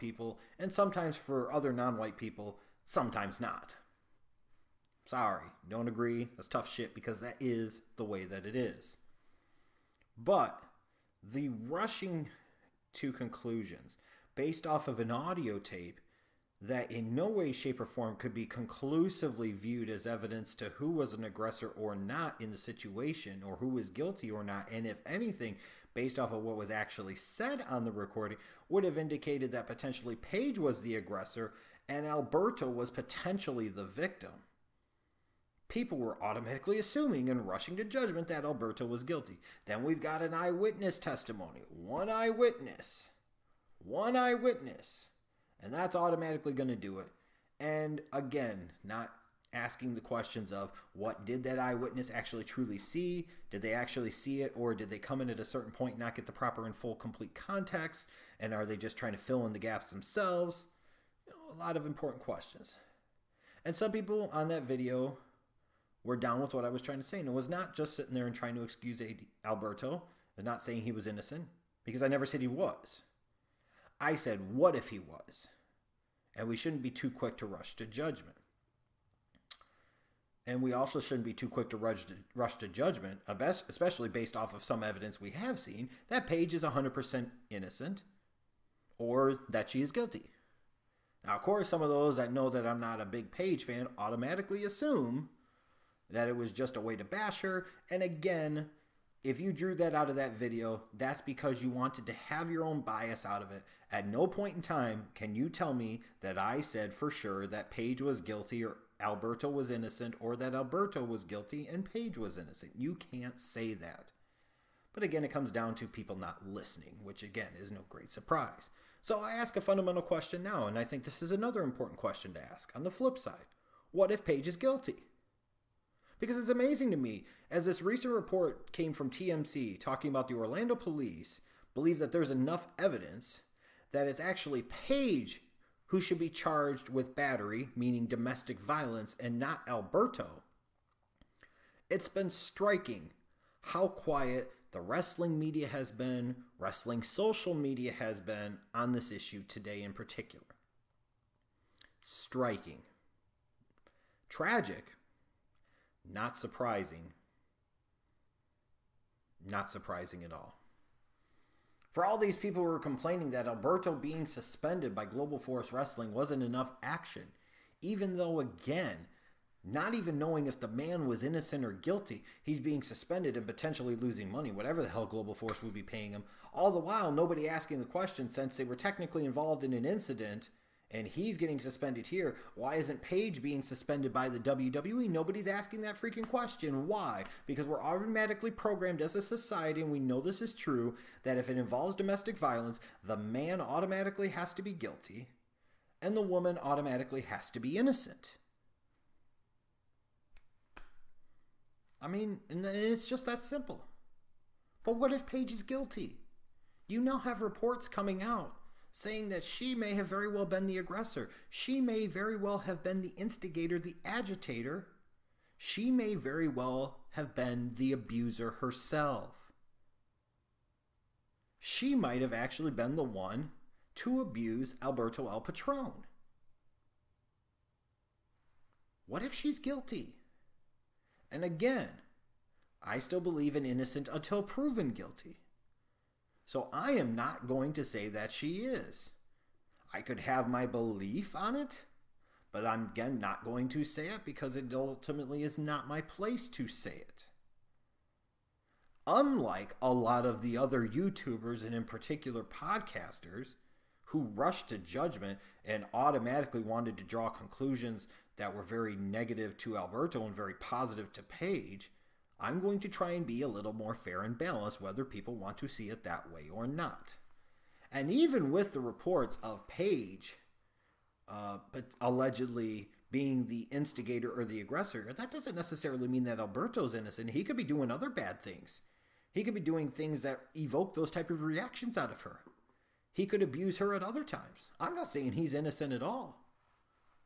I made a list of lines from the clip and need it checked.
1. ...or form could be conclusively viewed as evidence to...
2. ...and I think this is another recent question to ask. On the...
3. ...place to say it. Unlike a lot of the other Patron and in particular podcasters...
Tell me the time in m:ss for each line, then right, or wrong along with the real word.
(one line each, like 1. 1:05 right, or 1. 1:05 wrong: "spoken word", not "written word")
1. 0:17 right
2. 2:00 wrong: "important", not "recent"
3. 4:06 wrong: "YouTubers", not "Patron".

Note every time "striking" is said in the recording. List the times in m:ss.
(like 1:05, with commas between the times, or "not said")
2:22, 2:31.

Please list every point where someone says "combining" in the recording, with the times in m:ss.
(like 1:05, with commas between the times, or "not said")
not said.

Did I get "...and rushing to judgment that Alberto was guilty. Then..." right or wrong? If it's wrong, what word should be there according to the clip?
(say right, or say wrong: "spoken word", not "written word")
right.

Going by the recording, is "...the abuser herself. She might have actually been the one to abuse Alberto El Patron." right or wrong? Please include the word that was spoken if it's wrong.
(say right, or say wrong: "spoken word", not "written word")
right.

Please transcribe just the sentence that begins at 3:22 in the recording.
I mean, and it's just that simple.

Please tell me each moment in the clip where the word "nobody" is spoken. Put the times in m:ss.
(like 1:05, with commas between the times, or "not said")
2:57, 3:05.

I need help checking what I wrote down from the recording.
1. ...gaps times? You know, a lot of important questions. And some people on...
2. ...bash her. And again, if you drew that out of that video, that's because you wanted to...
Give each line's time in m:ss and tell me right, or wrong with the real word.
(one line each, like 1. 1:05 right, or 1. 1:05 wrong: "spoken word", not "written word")
1. 0:59 wrong: "themselves", not "times"
2. 1:37 right.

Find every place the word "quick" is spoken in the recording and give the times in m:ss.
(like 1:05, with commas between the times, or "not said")
1:17, 1:21.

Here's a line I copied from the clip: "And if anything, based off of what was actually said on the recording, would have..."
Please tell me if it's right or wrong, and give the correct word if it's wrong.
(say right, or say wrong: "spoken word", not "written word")
right.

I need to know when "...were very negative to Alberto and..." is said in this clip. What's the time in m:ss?
4:18.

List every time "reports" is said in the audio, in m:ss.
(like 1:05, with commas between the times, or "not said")
2:08, 3:27, 4:28.